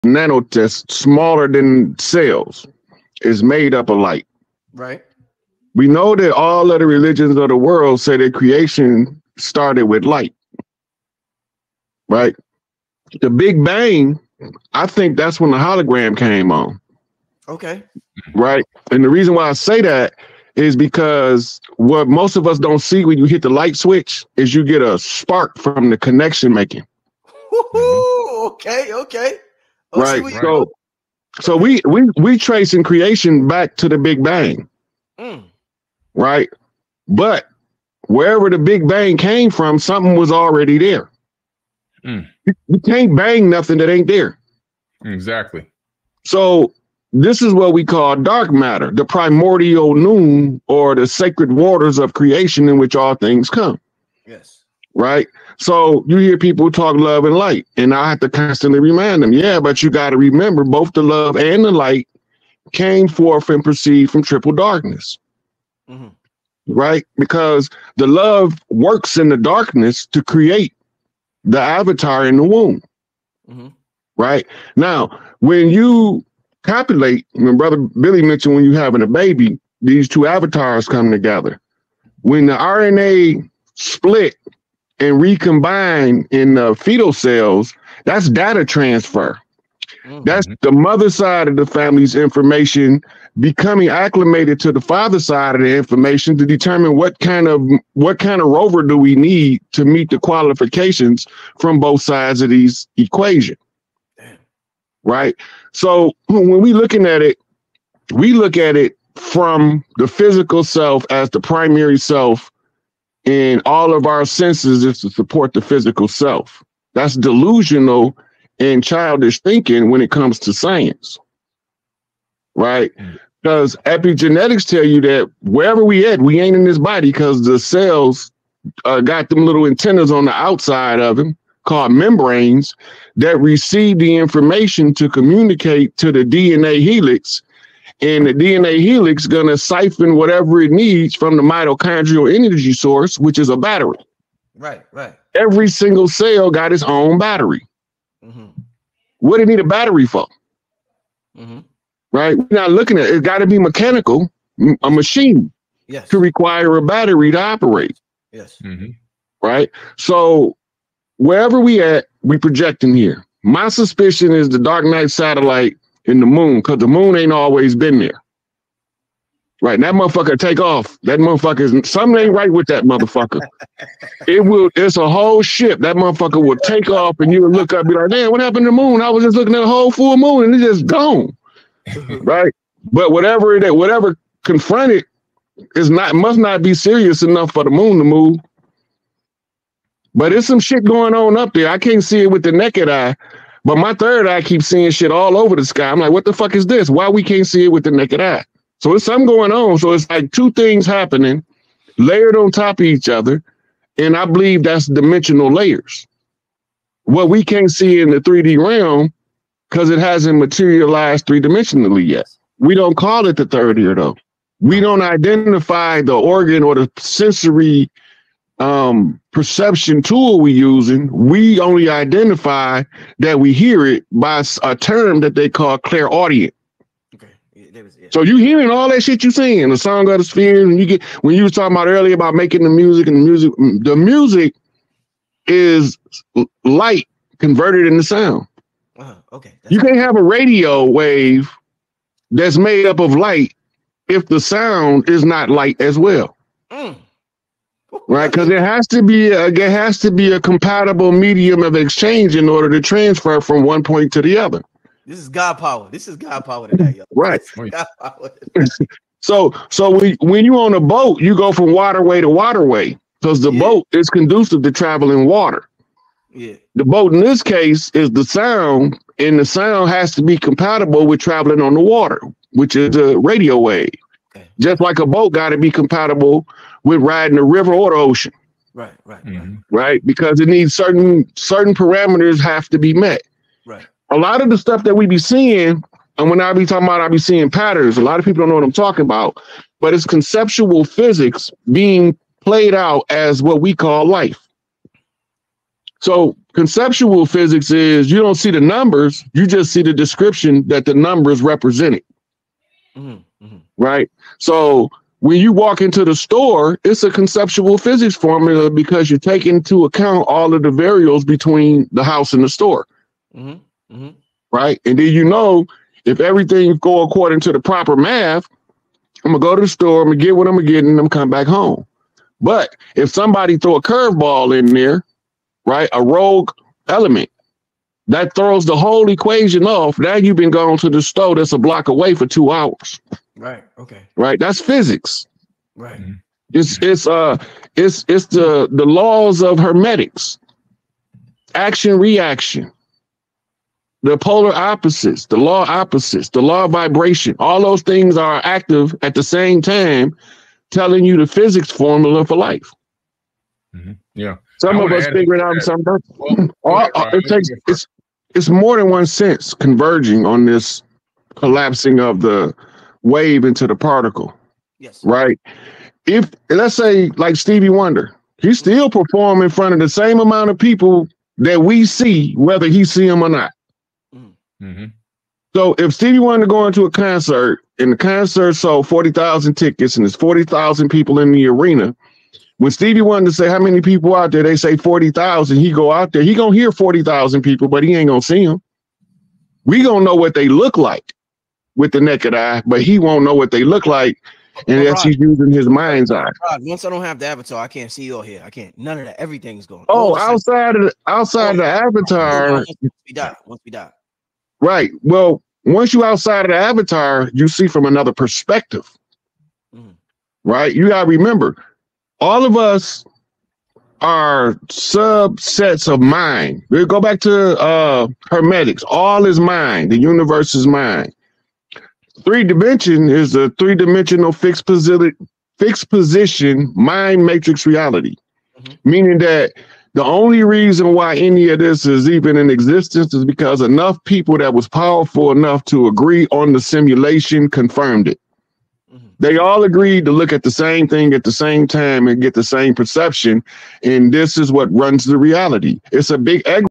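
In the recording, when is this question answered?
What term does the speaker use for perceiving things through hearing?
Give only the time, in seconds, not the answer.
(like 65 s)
225 s.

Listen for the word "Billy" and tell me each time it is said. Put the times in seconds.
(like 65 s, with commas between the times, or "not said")
77 s.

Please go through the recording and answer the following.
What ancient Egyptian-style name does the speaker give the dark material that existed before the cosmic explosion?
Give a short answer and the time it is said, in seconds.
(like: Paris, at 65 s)
primordial Nun, at 49 s.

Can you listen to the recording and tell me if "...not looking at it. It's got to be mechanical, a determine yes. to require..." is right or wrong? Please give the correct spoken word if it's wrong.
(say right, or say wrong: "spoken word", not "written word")
wrong: "machine", not "determine".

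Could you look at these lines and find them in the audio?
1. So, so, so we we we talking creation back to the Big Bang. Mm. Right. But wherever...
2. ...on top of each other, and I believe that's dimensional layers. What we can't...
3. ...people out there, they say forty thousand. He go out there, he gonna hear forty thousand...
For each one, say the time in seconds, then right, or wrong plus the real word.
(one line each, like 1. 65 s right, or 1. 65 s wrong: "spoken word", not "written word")
1. 30 s wrong: "tracing", not "talking"
2. 202 s right
3. 383 s right.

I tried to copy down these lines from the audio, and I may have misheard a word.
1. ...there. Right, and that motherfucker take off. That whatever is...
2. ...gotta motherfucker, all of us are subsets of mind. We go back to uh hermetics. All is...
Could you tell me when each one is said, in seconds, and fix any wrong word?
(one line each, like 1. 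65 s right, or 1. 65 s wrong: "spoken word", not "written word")
1. 167 s wrong: "motherfucker", not "whatever"
2. 410 s wrong: "remember", not "motherfucker".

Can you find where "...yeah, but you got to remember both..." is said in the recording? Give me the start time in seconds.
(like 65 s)
59 s.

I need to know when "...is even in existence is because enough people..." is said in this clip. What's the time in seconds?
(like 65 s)
431 s.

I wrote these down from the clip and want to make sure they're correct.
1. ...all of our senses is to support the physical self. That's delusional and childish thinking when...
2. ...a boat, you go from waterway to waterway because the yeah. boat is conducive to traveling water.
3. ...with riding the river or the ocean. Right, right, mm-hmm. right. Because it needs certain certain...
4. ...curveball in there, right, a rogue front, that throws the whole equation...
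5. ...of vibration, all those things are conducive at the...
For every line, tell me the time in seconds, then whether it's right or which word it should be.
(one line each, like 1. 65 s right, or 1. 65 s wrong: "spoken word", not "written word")
1. 113 s right
2. 260 s right
3. 276 s right
4. 323 s wrong: "element", not "front"
5. 346 s wrong: "active", not "conducive".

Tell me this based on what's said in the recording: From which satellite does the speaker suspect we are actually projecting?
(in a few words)
Dark Knight satellite.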